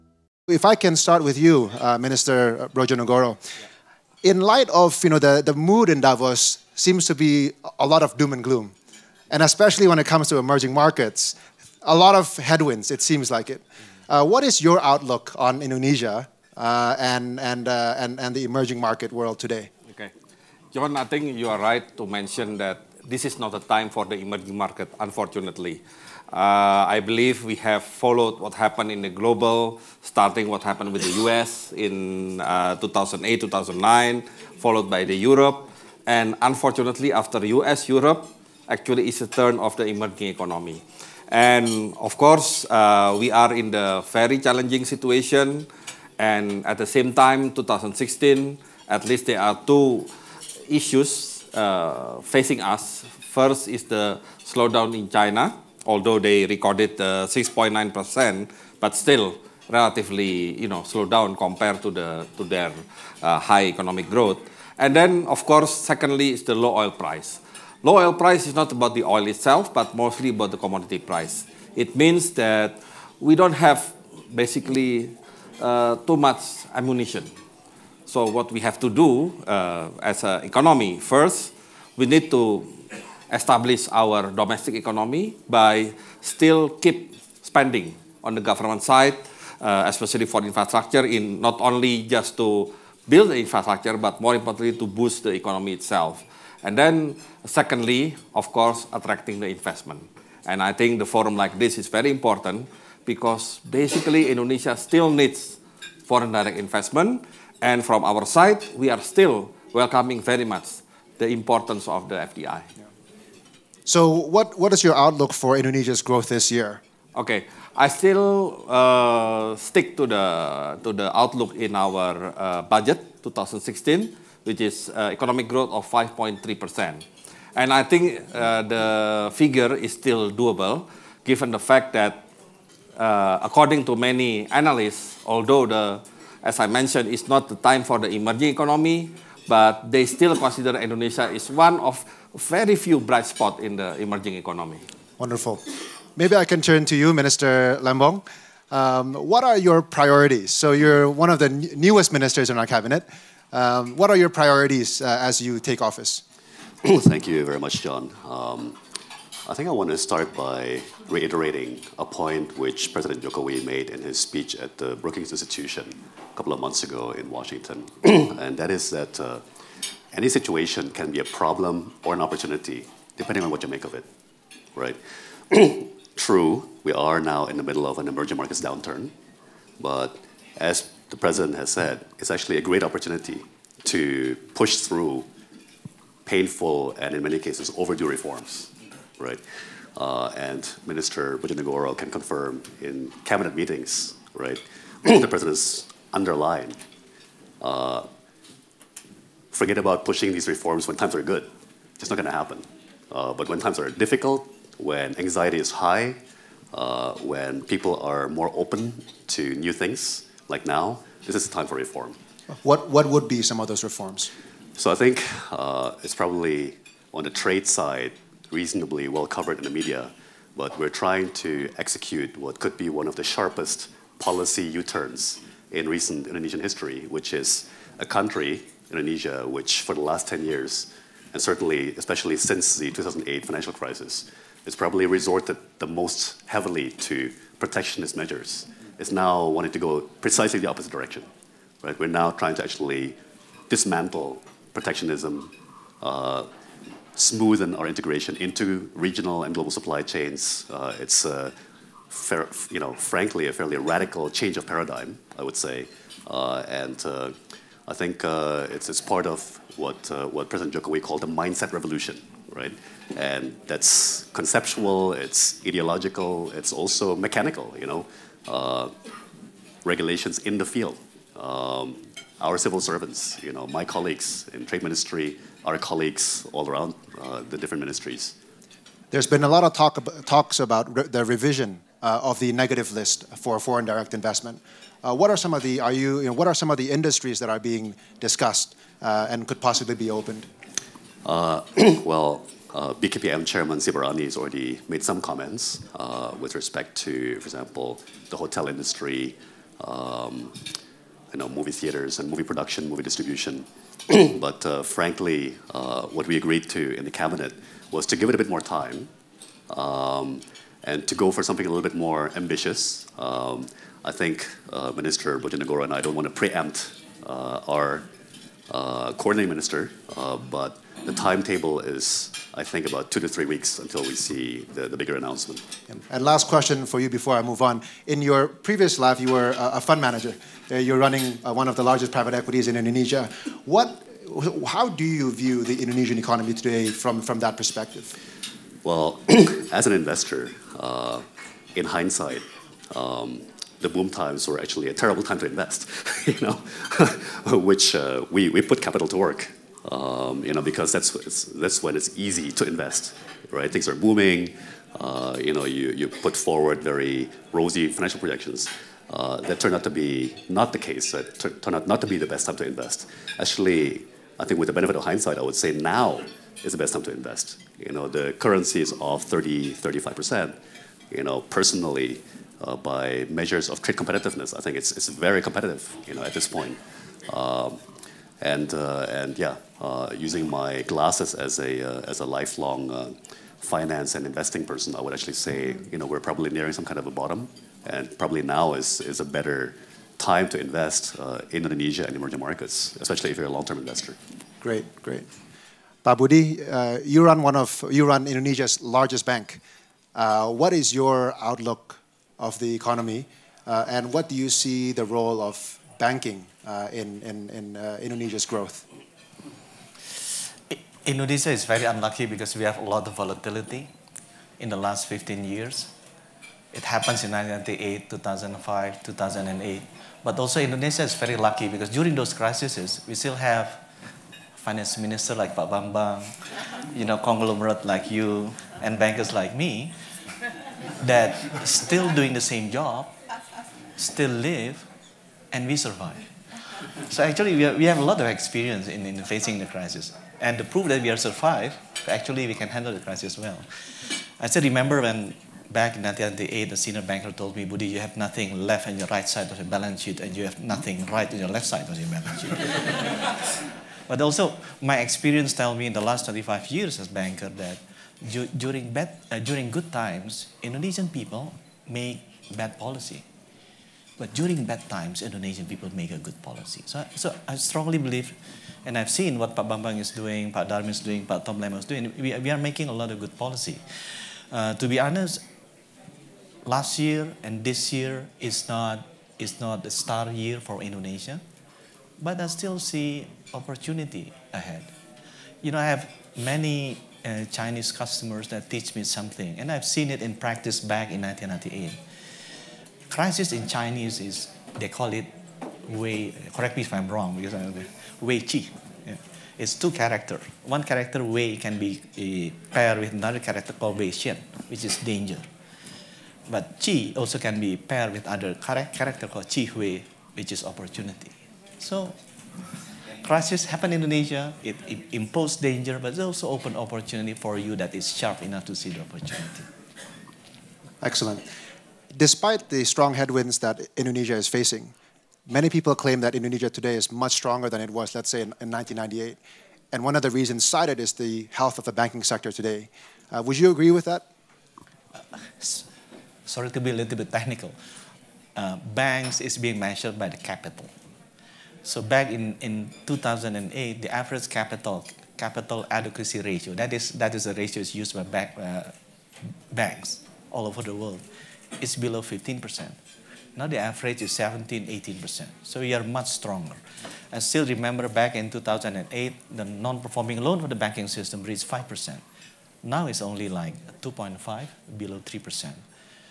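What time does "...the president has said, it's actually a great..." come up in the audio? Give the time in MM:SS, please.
03:01.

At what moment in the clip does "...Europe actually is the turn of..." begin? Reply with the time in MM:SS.
00:37.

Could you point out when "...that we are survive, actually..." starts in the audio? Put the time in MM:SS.
07:20.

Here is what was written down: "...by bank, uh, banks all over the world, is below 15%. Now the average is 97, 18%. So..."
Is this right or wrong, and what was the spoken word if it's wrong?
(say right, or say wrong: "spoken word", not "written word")
wrong: "17", not "97".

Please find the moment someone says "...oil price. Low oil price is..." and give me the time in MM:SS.
01:06.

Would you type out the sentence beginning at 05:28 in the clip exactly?
In your previous life, you were a, fund manager.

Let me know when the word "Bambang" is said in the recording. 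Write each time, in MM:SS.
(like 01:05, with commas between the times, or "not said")
07:05, 07:49.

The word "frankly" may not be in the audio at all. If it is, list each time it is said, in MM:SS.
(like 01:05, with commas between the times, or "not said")
04:12, 05:04.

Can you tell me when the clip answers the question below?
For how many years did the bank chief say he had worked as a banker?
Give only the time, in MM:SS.
07:36.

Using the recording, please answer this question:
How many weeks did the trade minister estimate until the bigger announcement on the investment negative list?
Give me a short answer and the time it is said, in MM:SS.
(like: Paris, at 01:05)
2 to 3 weeks, at 05:23.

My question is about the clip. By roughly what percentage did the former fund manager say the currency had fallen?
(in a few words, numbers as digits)
30-35%.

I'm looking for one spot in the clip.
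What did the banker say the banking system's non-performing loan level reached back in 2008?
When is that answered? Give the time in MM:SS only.
09:21.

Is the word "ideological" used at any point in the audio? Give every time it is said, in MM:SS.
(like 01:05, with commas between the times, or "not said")
04:25.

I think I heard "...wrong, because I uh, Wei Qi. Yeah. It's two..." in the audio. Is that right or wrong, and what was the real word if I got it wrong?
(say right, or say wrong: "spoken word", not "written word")
right.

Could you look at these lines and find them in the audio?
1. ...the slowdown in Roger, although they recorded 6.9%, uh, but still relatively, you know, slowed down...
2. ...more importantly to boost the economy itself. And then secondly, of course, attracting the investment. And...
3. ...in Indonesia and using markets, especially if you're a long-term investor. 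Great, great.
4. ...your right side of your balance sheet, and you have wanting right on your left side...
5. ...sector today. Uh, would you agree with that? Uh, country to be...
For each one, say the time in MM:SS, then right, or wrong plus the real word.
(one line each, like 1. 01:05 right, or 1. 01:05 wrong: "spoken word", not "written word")
1. 00:53 wrong: "China", not "Roger"
2. 01:34 right
3. 06:31 wrong: "emerging", not "using"
4. 07:28 wrong: "nothing", not "wanting"
5. 08:52 wrong: "sorry", not "country".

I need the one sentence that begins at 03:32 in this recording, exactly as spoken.
What, what would be some of those reforms?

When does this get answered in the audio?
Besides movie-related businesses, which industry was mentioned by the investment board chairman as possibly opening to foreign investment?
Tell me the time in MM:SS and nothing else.
04:58.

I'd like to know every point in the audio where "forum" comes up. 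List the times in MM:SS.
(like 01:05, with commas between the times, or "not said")
01:41.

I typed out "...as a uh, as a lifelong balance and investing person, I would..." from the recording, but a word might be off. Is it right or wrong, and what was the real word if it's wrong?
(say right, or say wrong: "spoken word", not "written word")
wrong: "finance", not "balance".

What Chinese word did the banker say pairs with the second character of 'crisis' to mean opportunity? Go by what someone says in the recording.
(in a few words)
Qi Hui.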